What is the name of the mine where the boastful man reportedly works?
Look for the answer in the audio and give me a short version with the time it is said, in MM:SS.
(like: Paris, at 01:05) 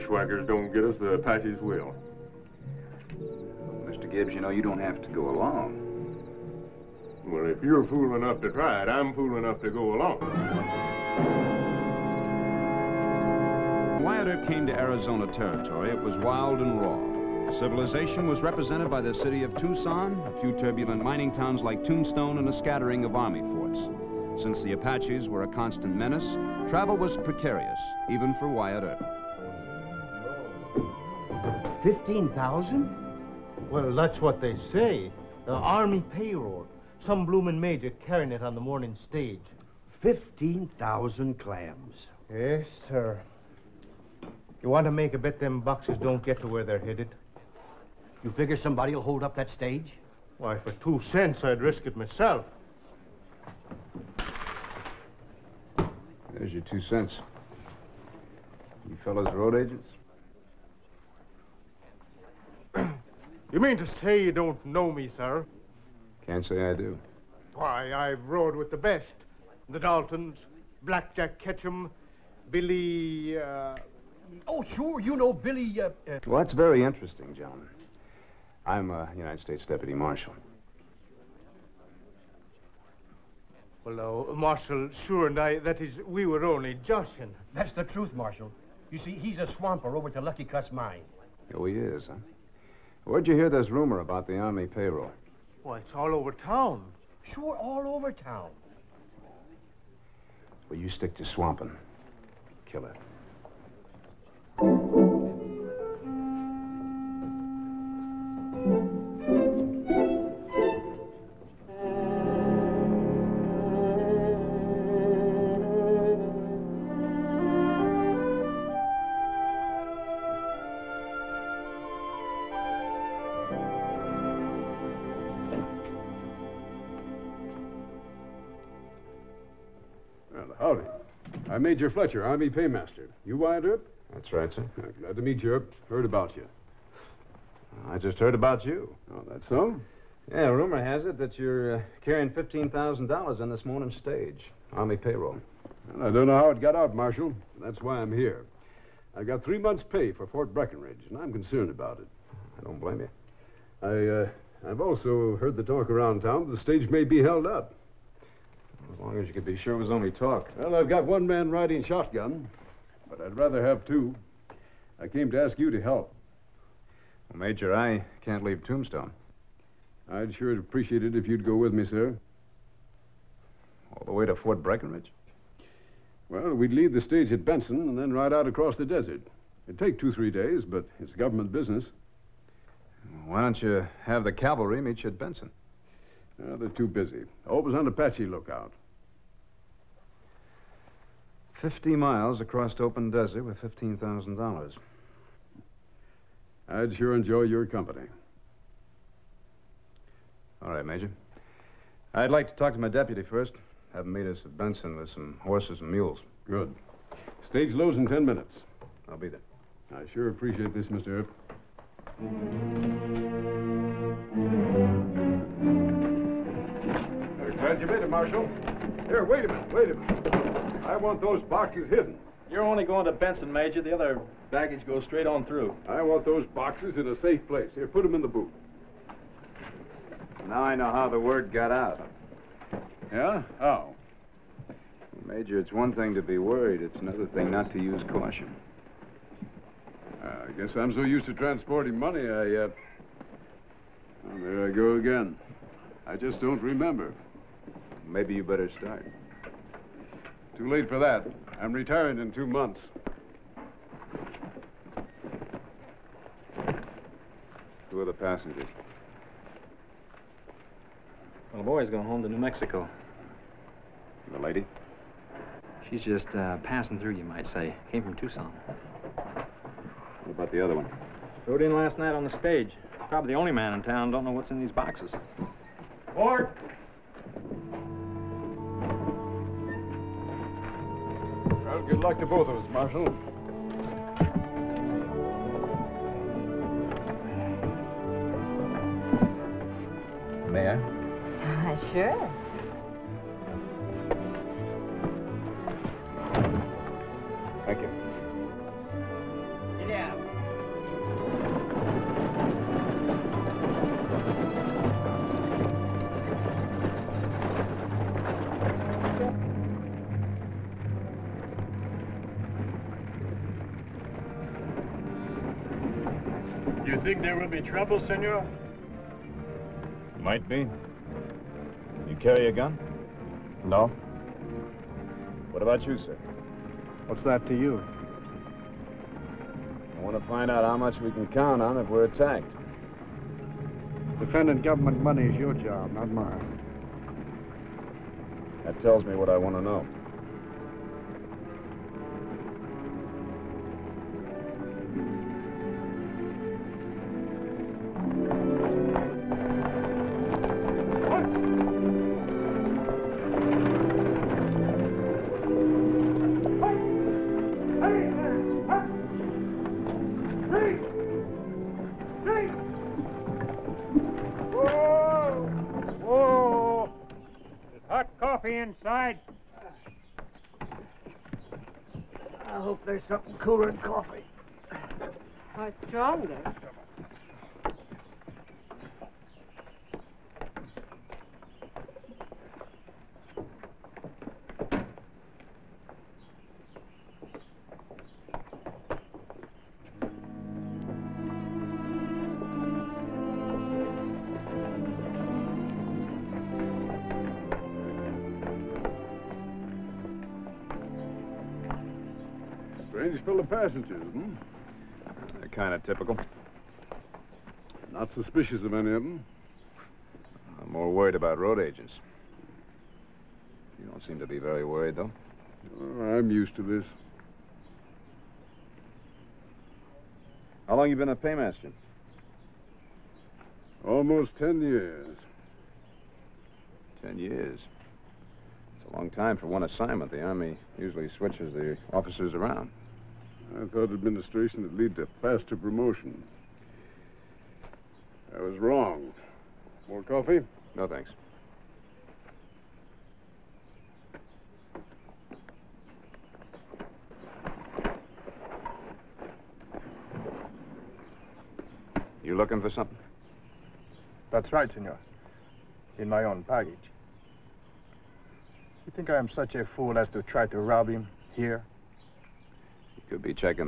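Lucky Cuss Mine, at 01:30.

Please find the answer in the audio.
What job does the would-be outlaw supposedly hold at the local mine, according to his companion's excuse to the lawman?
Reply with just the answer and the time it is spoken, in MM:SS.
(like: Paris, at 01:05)
swamper, at 01:29.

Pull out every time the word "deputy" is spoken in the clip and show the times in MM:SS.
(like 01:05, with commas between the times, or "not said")
01:19, 03:22.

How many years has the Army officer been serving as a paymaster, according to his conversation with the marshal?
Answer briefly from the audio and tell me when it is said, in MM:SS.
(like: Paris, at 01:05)
10, at 07:03.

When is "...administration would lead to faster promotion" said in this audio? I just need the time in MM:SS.
07:13.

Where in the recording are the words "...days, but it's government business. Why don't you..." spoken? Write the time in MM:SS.
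03:00.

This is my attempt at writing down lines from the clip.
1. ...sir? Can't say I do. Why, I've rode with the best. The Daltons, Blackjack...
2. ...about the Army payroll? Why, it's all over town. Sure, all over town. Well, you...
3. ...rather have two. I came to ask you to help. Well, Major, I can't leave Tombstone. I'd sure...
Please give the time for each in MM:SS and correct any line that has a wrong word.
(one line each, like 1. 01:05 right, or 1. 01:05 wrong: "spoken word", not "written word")
1. 01:05 right
2. 01:33 right
3. 02:43 right.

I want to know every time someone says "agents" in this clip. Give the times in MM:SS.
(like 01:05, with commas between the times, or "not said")
00:59, 06:51.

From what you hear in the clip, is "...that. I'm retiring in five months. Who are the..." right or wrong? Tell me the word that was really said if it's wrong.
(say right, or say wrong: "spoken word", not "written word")
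wrong: "two", not "five".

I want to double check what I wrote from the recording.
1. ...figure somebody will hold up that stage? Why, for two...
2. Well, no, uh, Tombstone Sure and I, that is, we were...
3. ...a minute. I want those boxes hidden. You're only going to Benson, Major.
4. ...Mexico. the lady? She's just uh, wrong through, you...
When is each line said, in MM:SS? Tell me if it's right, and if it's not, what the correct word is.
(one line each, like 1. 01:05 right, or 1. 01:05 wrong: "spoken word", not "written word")
1. 00:48 right
2. 01:23 wrong: "Marshal", not "Tombstone"
3. 03:39 right
4. 04:22 wrong: "passing", not "wrong".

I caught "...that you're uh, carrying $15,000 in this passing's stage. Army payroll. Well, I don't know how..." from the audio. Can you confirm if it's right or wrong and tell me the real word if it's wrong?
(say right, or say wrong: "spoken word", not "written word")
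wrong: "morning", not "passing".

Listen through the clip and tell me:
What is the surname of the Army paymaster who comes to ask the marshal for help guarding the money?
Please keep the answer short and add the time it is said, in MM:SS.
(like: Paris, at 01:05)
Fletcher, at 02:11.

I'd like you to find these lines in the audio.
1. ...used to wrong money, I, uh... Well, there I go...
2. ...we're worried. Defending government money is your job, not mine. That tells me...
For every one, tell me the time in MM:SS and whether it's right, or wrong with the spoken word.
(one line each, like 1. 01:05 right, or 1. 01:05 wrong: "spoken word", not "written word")
1. 04:01 wrong: "transporting", not "wrong"
2. 05:31 wrong: "attacked", not "worried".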